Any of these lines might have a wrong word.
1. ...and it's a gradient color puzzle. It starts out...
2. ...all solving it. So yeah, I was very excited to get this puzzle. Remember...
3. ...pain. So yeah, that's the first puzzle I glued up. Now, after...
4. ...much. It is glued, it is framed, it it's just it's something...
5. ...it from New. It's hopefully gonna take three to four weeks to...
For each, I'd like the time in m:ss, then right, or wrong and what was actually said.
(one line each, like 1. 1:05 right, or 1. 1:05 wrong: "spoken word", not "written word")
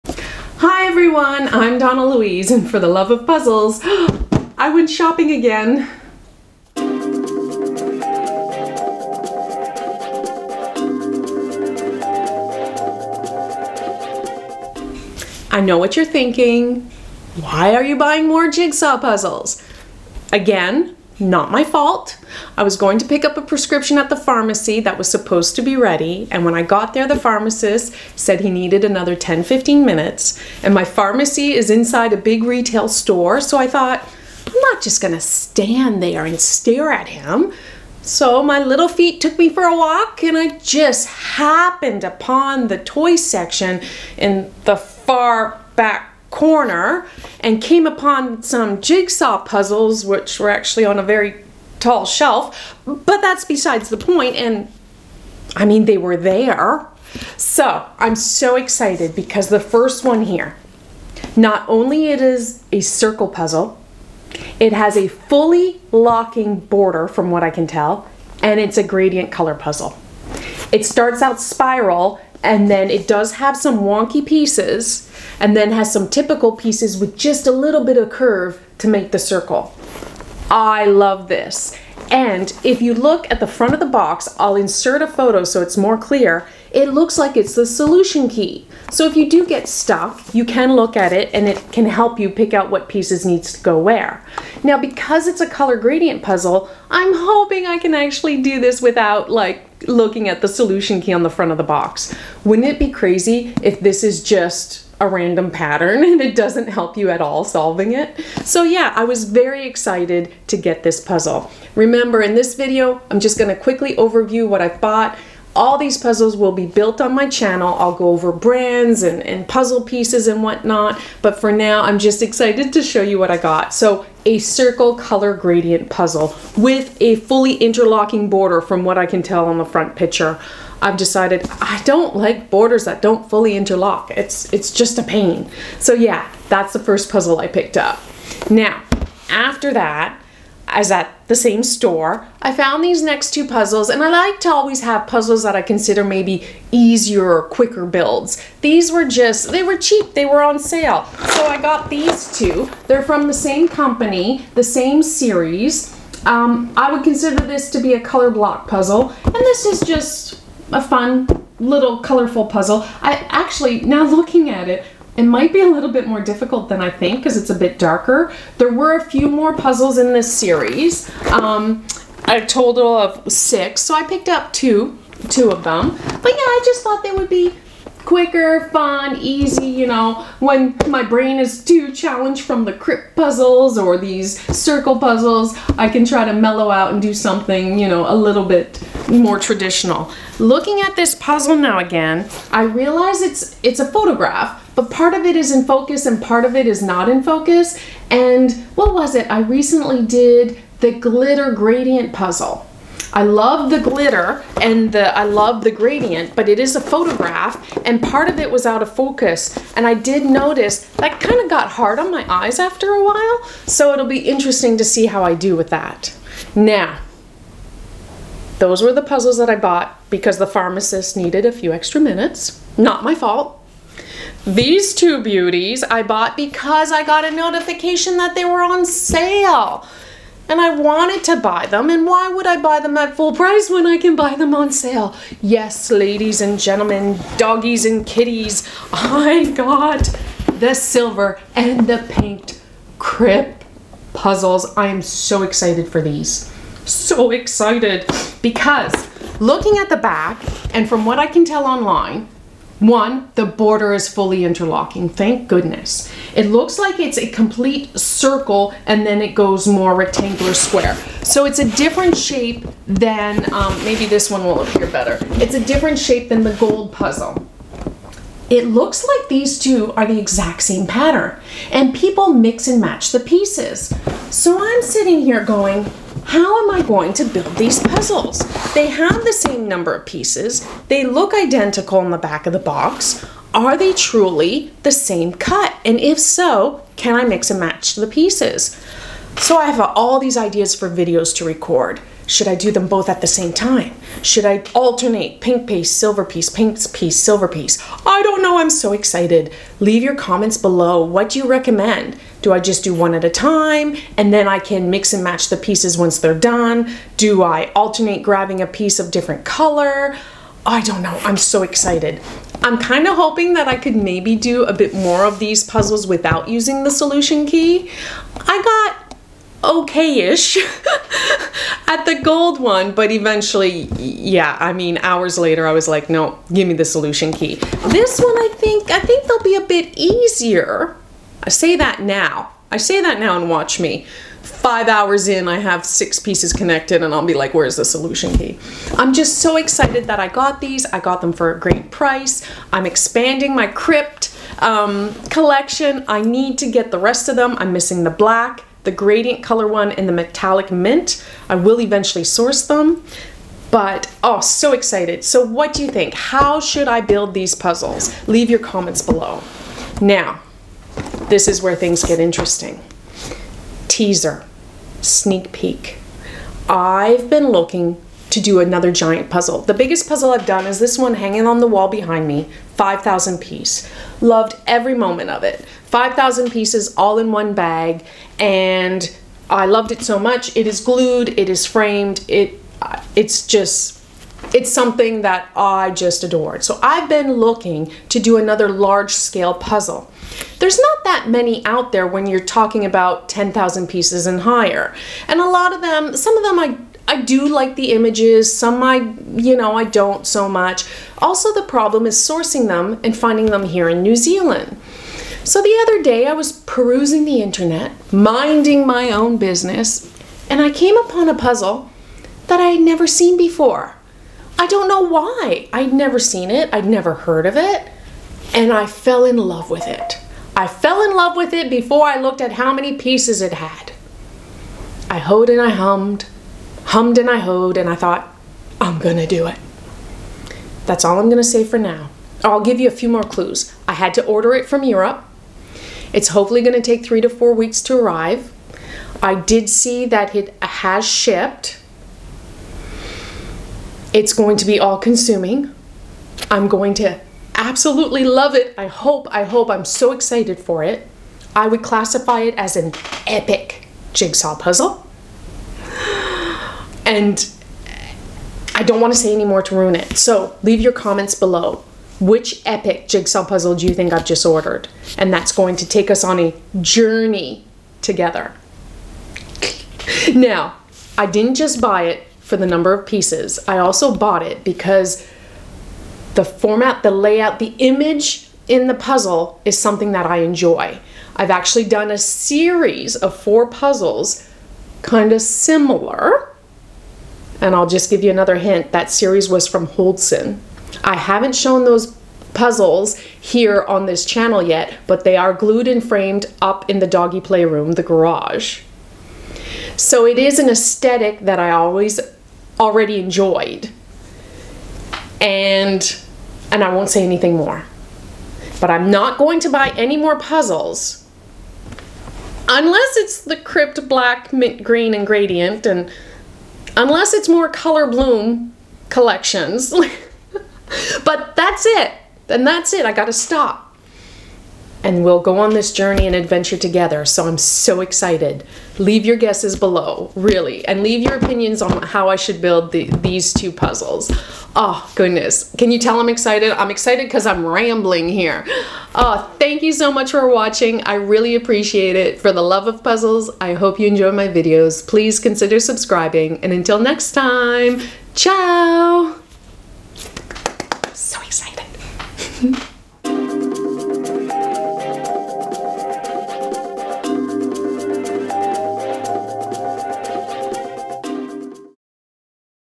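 1. 1:08 right
2. 1:47 right
3. 2:15 wrong: "picked", not "glued"
4. 6:20 right
5. 7:14 wrong: "Europe", not "New".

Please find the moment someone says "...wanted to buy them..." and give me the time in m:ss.
3:50.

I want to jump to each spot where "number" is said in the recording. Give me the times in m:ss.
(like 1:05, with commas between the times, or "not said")
4:39, 7:52.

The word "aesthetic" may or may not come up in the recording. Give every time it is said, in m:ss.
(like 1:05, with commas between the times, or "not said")
8:20.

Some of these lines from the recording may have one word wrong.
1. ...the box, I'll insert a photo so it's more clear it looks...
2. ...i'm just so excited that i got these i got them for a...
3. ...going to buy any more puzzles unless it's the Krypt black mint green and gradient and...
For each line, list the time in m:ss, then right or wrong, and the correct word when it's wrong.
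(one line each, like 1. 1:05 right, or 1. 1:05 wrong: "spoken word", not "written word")
1. 1:23 right
2. 5:38 right
3. 8:29 right.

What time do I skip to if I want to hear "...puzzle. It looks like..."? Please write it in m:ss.
4:26.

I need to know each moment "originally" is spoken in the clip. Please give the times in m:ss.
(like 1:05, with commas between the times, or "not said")
not said.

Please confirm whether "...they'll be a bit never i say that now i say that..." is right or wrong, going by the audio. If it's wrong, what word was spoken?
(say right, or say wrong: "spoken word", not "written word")
wrong: "easier", not "never".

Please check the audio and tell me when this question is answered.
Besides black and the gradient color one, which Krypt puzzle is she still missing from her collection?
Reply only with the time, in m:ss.
5:50.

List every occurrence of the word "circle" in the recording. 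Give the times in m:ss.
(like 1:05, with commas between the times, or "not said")
1:02, 1:19, 2:04, 3:04, 4:17.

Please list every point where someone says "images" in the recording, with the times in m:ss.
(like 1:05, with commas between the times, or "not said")
6:37, 7:57.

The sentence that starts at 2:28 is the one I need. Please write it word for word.
These were just, they were cheap, they were on sale.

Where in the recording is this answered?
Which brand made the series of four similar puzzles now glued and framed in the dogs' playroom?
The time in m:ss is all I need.
8:09.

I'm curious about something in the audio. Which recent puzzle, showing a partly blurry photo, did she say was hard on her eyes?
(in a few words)
glitter gradient puzzle.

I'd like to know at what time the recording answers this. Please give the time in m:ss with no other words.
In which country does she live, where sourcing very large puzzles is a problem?
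6:44.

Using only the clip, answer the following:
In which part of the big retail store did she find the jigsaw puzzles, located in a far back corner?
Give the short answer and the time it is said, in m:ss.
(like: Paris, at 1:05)
toy section, at 0:42.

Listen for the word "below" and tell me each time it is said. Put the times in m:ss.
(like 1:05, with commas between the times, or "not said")
5:00, 5:59, 7:41, 8:49.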